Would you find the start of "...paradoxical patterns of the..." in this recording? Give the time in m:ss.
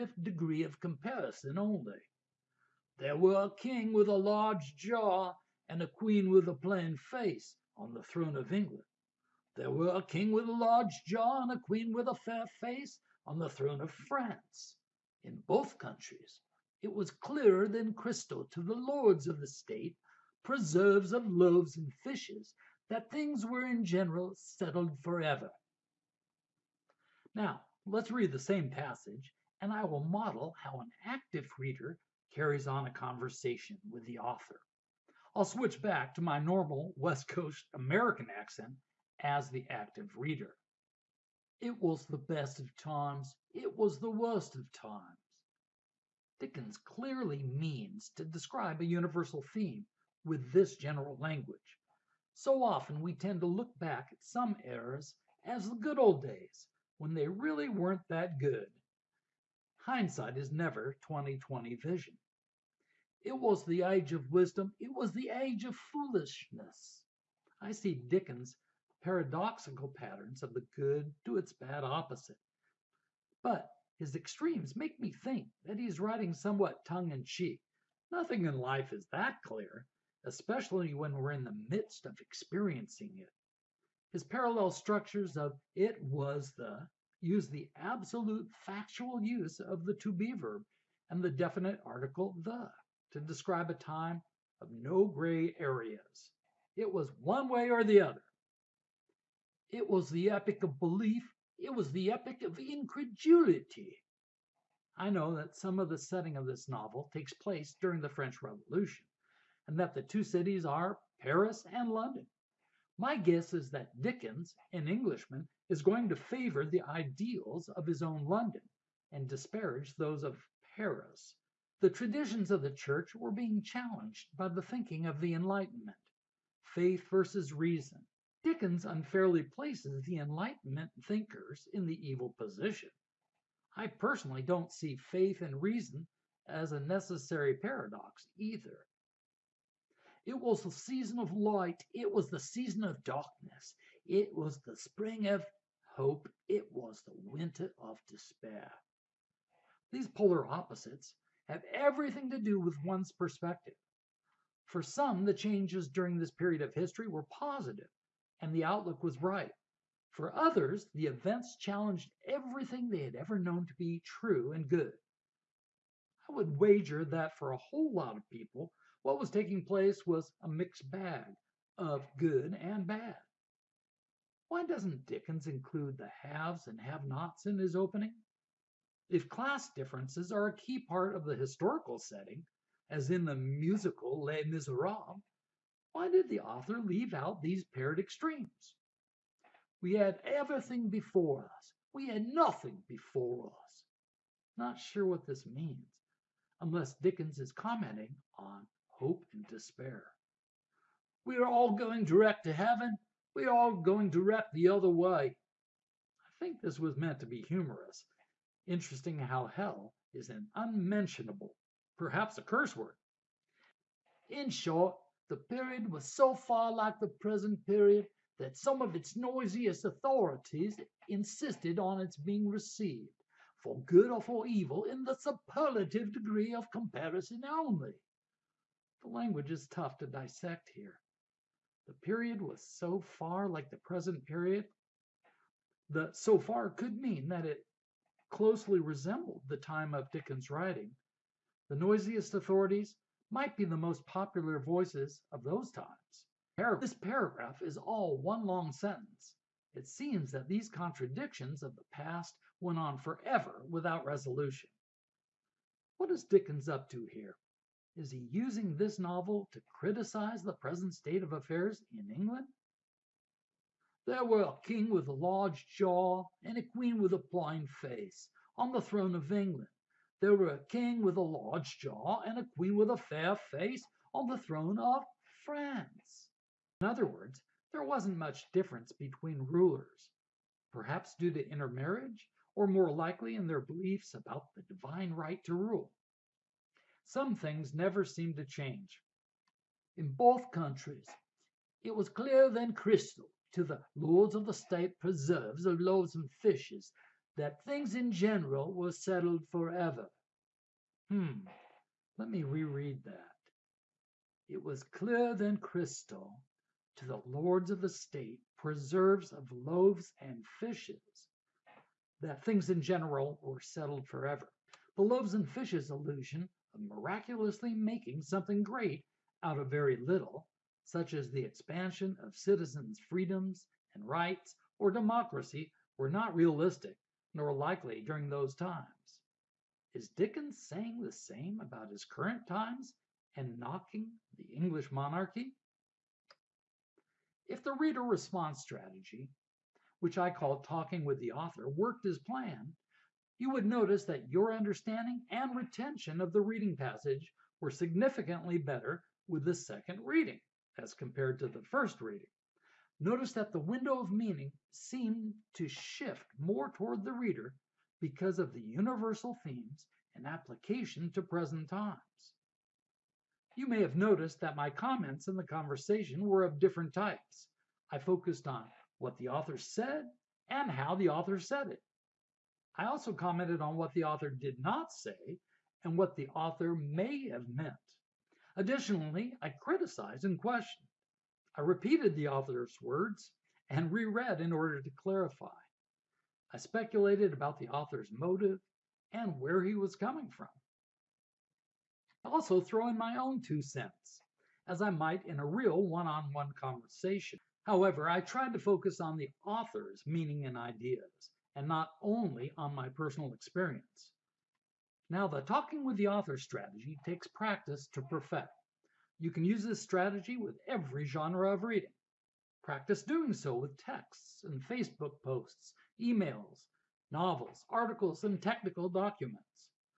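1:09.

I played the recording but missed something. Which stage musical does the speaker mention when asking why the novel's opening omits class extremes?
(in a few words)
Les Miserables.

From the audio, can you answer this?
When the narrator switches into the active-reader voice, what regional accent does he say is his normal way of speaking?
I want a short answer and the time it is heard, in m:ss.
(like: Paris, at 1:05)
West Coast American, at 0:36.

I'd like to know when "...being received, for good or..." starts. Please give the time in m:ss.
3:42.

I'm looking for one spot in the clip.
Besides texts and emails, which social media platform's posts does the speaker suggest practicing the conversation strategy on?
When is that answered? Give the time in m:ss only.
6:54.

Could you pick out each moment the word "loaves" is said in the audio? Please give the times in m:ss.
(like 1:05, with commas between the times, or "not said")
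0:21, 4:55, 5:09, 5:15.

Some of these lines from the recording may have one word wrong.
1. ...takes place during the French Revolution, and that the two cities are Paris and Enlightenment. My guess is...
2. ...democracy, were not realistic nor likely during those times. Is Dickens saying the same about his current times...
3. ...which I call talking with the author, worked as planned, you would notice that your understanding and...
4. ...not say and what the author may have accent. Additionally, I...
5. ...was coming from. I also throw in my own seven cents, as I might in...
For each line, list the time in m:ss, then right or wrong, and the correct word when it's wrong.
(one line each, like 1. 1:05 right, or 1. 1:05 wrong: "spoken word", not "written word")
1. 1:47 wrong: "London", not "Enlightenment"
2. 5:24 right
3. 5:40 right
4. 6:14 wrong: "meant", not "accent"
5. 6:29 wrong: "two", not "seven".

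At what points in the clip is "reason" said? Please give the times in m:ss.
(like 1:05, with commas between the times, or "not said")
2:07, 2:15.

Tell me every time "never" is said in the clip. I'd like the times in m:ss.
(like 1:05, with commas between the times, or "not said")
1:00, 4:47.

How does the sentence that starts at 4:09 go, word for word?
It seems that these contradictions of the past went on forever without resolution.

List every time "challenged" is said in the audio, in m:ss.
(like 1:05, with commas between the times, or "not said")
2:03, 2:41.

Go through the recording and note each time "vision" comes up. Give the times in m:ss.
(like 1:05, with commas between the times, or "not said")
1:01.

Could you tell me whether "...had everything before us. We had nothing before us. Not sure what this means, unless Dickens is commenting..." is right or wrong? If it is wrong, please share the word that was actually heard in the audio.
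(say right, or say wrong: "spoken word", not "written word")
right.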